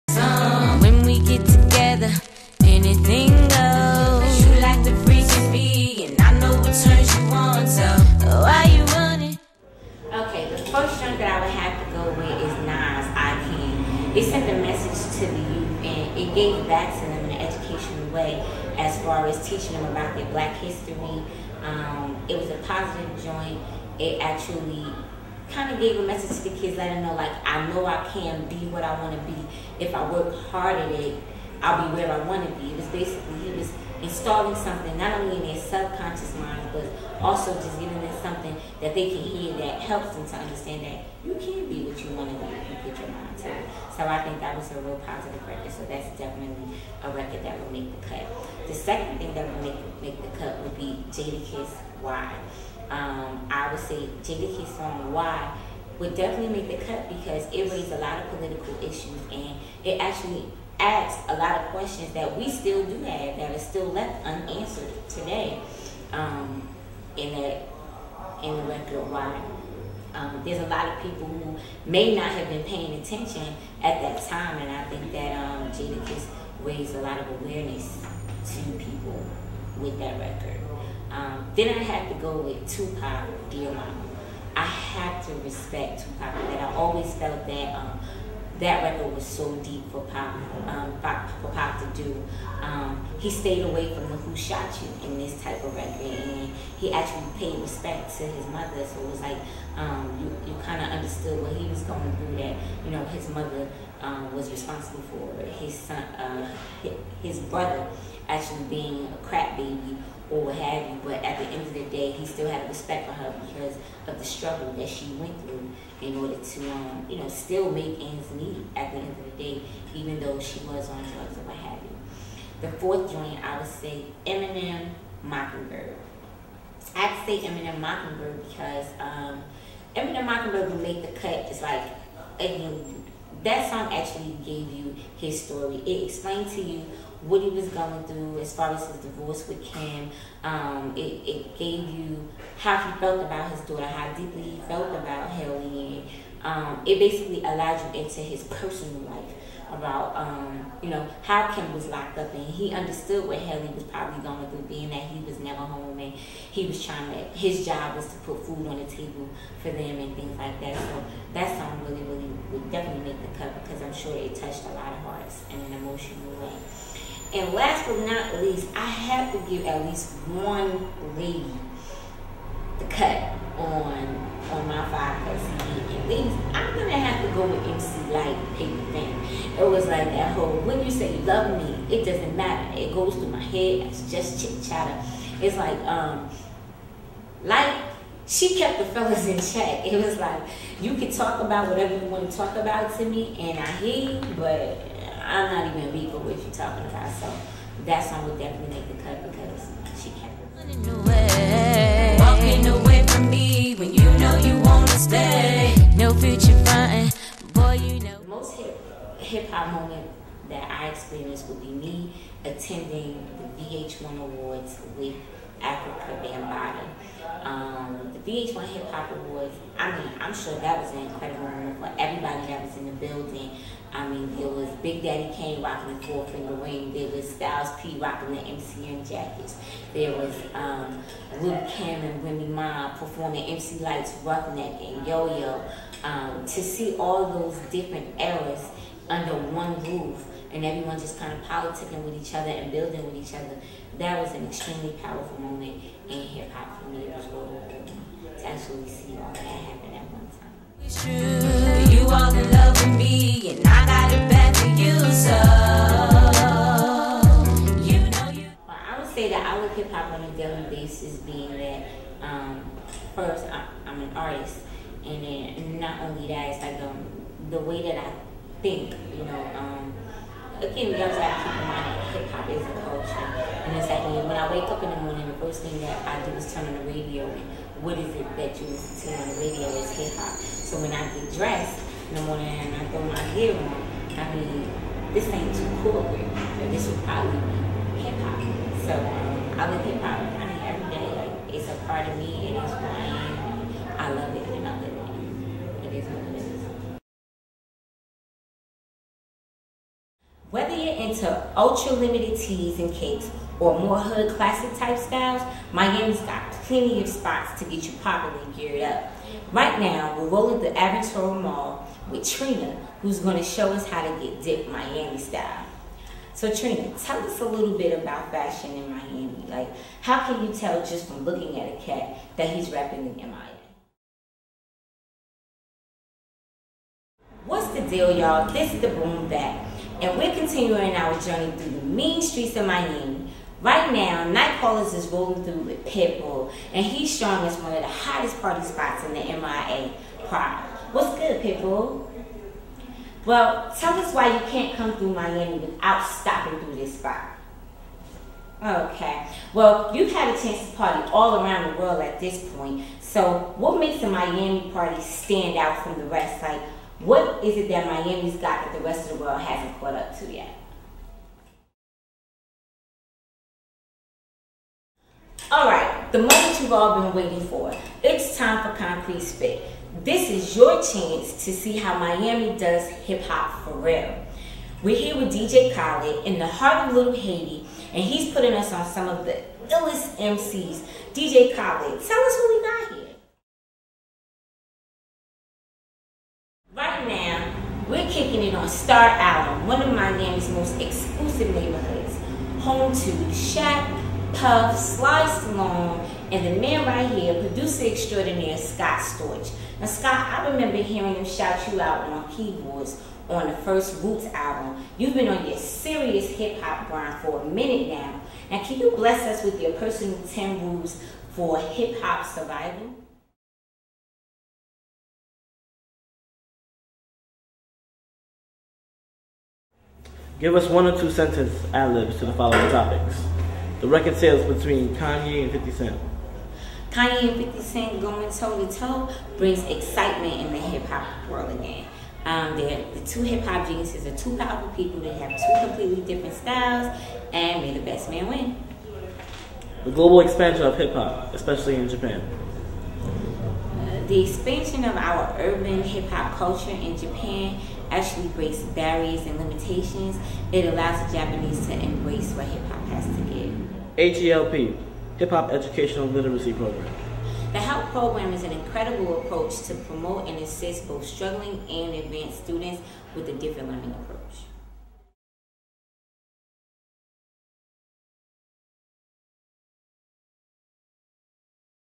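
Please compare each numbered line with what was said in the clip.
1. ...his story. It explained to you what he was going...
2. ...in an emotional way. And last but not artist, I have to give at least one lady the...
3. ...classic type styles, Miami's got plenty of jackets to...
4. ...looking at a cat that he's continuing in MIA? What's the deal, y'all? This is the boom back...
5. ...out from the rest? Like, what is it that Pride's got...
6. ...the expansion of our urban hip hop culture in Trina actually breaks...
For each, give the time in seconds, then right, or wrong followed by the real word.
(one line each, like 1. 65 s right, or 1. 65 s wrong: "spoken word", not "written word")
1. 135 s right
2. 165 s wrong: "least", not "artist"
3. 304 s wrong: "spots", not "jackets"
4. 321 s wrong: "rapping", not "continuing"
5. 355 s wrong: "Miami", not "Pride"
6. 444 s wrong: "Japan", not "Trina".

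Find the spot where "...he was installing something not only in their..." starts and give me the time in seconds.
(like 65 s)
33 s.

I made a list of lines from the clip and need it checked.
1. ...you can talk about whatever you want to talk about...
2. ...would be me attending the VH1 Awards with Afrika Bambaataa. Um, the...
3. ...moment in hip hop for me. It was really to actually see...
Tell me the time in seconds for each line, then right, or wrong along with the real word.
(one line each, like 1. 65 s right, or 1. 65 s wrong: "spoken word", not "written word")
1. 190 s right
2. 211 s right
3. 245 s right.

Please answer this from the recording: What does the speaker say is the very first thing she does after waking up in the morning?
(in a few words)
Turn on the radio.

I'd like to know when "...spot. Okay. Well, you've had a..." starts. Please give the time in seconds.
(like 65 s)
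346 s.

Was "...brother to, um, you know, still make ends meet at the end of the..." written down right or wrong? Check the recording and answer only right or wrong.
wrong.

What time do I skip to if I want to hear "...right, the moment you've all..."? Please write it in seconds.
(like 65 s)
365 s.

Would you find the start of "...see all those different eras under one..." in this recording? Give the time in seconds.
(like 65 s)
236 s.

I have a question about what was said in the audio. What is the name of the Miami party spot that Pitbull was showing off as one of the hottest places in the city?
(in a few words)
Pride.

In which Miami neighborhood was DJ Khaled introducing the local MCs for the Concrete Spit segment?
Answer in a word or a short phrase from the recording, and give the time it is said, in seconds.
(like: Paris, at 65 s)
Little Haiti, at 376 s.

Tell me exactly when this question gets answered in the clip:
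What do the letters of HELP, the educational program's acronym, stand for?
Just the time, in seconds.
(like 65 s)
455 s.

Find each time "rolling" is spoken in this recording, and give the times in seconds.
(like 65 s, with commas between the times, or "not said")
310 s, 335 s.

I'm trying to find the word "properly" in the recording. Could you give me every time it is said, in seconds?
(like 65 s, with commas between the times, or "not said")
307 s.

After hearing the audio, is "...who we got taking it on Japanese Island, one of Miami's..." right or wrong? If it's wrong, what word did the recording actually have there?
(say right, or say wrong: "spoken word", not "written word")
wrong: "Star", not "Japanese".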